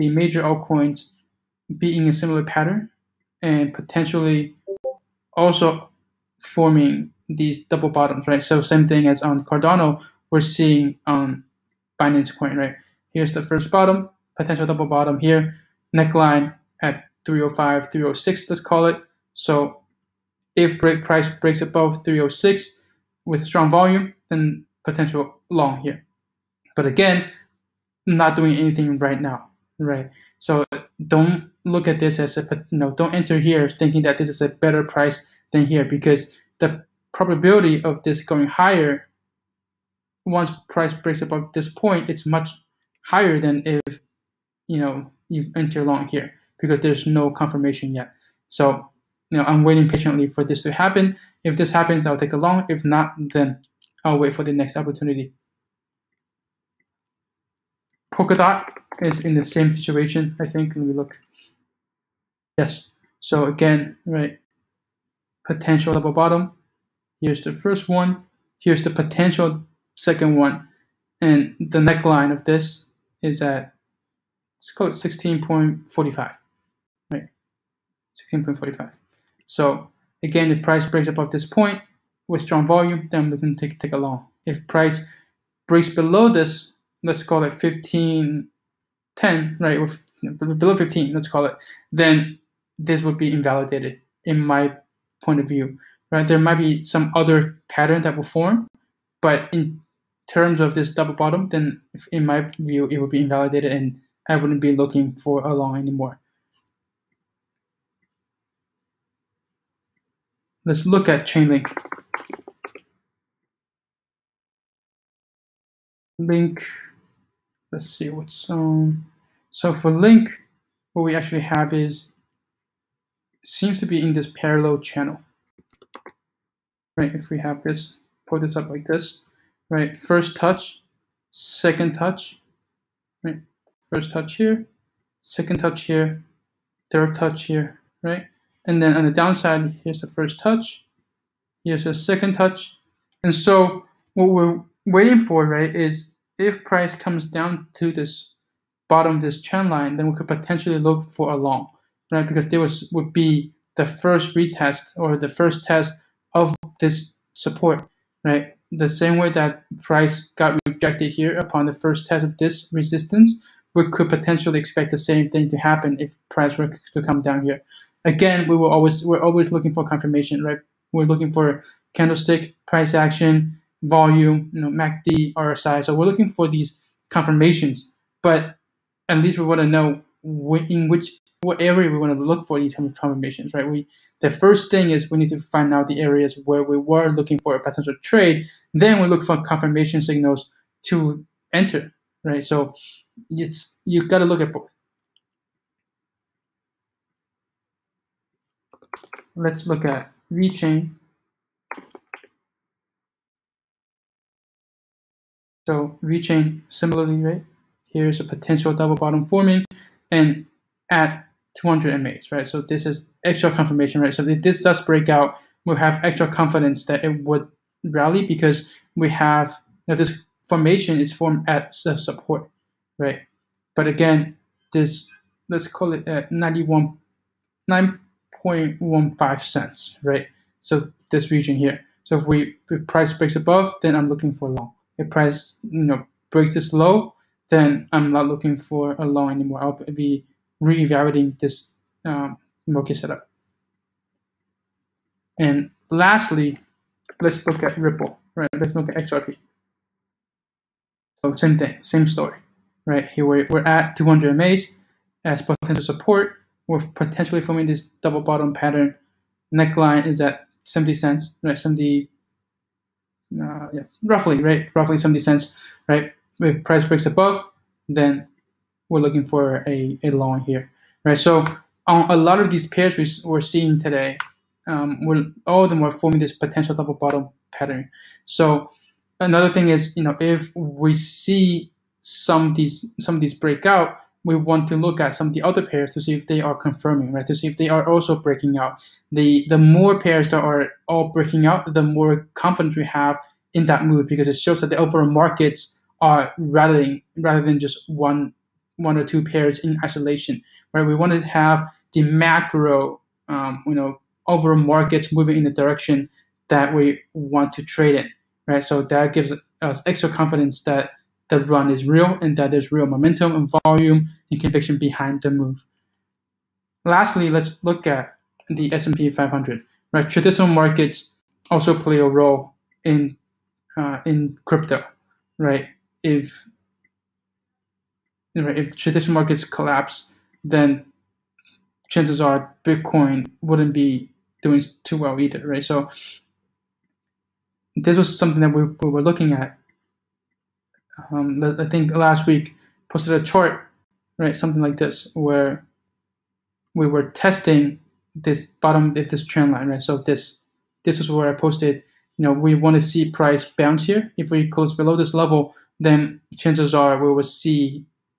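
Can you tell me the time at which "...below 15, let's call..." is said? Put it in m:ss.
1:30.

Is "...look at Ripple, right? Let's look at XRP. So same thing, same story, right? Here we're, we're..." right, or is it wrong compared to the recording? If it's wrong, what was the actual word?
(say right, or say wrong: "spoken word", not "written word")
right.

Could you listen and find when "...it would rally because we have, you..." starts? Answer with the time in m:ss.
3:37.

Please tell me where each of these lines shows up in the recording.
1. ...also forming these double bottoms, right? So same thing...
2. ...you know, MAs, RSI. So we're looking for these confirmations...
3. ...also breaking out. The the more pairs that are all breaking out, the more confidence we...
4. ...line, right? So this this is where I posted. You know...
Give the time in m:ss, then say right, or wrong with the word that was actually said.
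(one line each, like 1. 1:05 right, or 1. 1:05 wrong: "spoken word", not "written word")
1. 0:05 right
2. 2:54 wrong: "MACD", not "MAs"
3. 4:47 right
4. 5:49 right.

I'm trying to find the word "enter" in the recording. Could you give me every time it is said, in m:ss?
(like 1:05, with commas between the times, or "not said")
0:33, 0:45, 3:11.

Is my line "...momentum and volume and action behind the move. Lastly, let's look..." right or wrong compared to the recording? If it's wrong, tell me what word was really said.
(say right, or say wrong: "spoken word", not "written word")
wrong: "conviction", not "action".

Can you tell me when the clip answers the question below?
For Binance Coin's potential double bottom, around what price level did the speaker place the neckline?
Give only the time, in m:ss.
0:17.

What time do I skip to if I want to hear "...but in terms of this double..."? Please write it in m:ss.
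1:39.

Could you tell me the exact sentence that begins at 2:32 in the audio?
Because there was would be the first retest or the first test of this support, right?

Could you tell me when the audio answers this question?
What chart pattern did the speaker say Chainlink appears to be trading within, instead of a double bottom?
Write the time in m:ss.
2:04.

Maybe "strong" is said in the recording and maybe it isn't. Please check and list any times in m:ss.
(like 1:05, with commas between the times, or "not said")
0:23, 1:22.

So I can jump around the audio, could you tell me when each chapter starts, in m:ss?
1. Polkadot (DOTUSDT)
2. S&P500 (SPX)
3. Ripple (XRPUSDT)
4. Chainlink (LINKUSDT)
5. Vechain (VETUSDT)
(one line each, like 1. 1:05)
1. 0:59
2. 5:19
3. 4:09
4. 1:54
5. 3:19.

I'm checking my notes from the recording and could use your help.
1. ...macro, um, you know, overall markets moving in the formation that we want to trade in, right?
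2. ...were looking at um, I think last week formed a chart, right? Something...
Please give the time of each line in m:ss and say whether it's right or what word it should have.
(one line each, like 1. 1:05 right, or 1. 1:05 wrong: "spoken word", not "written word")
1. 5:02 wrong: "direction", not "formation"
2. 5:38 wrong: "posted", not "formed".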